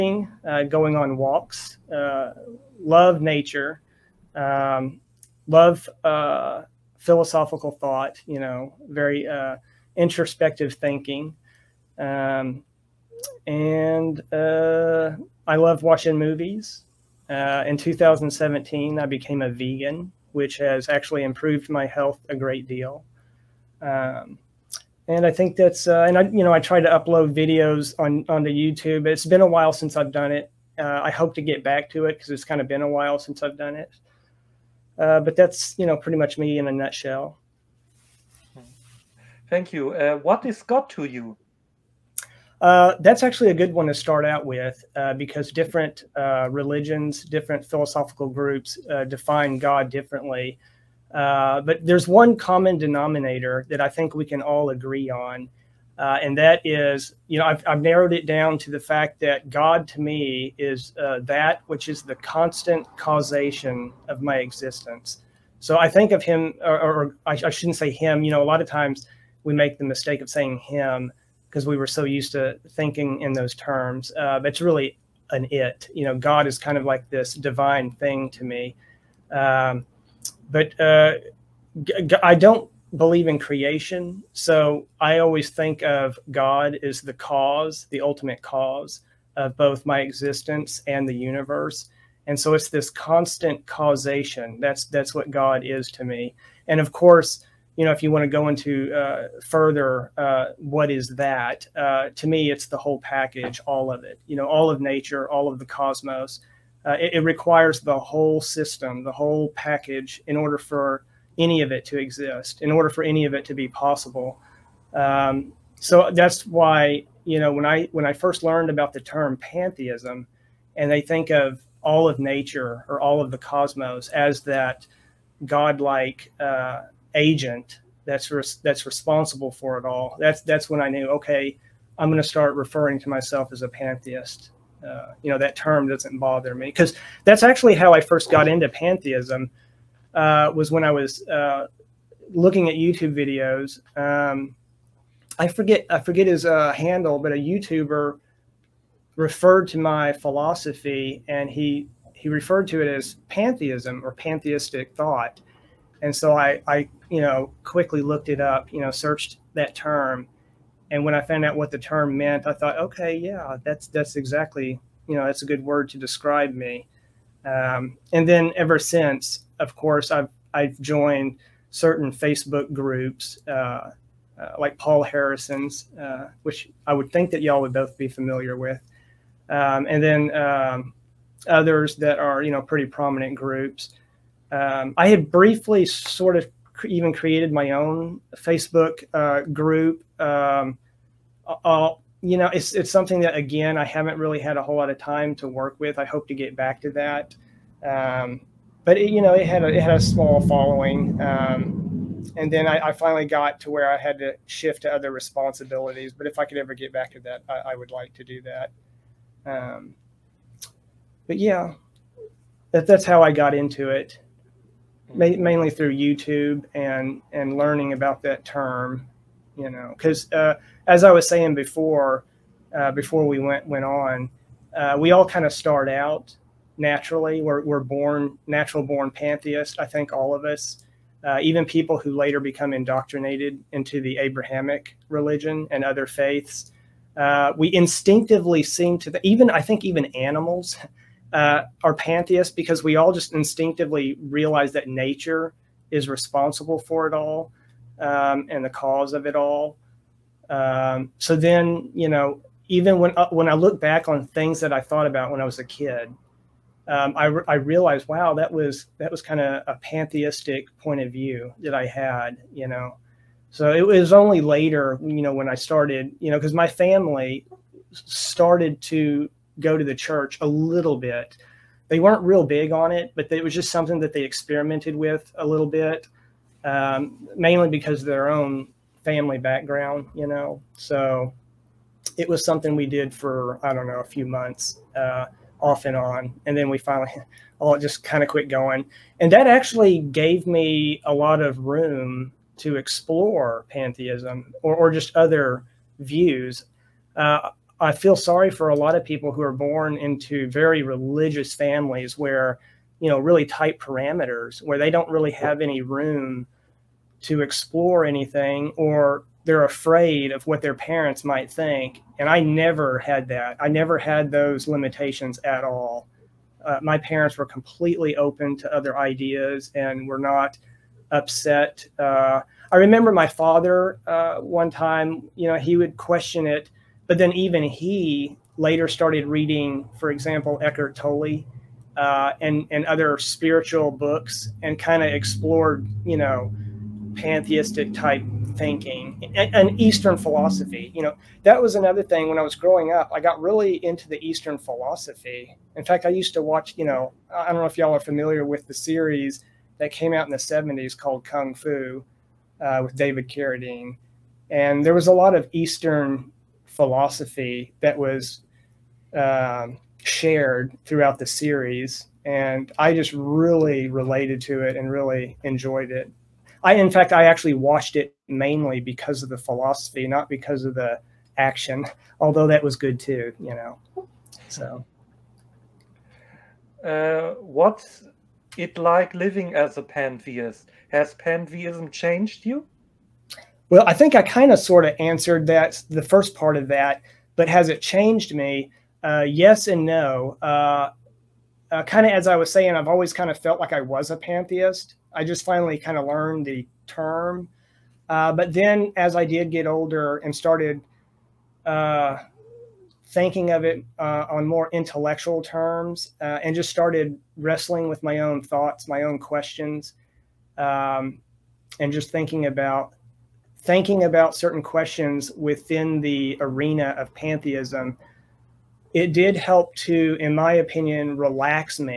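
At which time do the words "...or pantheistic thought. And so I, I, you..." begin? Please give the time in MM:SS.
02:34.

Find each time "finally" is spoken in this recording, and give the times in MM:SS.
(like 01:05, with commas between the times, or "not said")
03:22, 04:46, 06:35.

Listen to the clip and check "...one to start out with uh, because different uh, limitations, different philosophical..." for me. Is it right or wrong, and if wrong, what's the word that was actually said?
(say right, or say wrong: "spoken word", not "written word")
wrong: "religions", not "limitations".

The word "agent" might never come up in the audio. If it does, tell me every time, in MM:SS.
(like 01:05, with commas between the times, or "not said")
02:07.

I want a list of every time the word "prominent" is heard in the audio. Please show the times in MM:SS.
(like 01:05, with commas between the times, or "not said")
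03:02.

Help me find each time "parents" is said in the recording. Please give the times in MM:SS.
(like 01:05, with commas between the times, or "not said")
05:10, 05:16.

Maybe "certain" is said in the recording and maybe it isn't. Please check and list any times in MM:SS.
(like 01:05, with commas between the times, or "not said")
02:51, 06:54.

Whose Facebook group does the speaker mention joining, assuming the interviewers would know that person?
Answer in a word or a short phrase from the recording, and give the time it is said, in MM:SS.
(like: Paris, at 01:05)
Paul Harrison, at 02:54.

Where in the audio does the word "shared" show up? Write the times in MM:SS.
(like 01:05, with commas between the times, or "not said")
06:00.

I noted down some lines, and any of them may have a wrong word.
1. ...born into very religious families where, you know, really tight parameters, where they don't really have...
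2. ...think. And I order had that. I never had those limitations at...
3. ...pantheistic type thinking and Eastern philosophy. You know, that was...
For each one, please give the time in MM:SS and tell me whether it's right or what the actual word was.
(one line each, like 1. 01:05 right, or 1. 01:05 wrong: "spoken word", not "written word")
1. 04:59 right
2. 05:11 wrong: "never", not "order"
3. 05:37 right.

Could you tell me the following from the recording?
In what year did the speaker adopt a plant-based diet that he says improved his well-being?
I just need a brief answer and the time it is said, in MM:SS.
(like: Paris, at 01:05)
2017, at 00:17.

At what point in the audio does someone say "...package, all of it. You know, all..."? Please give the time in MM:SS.
01:42.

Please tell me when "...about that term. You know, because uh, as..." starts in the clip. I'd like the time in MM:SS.
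03:37.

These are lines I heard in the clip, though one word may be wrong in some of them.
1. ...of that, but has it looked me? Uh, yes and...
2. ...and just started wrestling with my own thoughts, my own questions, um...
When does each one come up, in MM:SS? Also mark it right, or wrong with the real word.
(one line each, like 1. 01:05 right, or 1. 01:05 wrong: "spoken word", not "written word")
1. 06:26 wrong: "changed", not "looked"
2. 06:46 right.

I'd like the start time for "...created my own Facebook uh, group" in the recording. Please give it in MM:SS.
03:07.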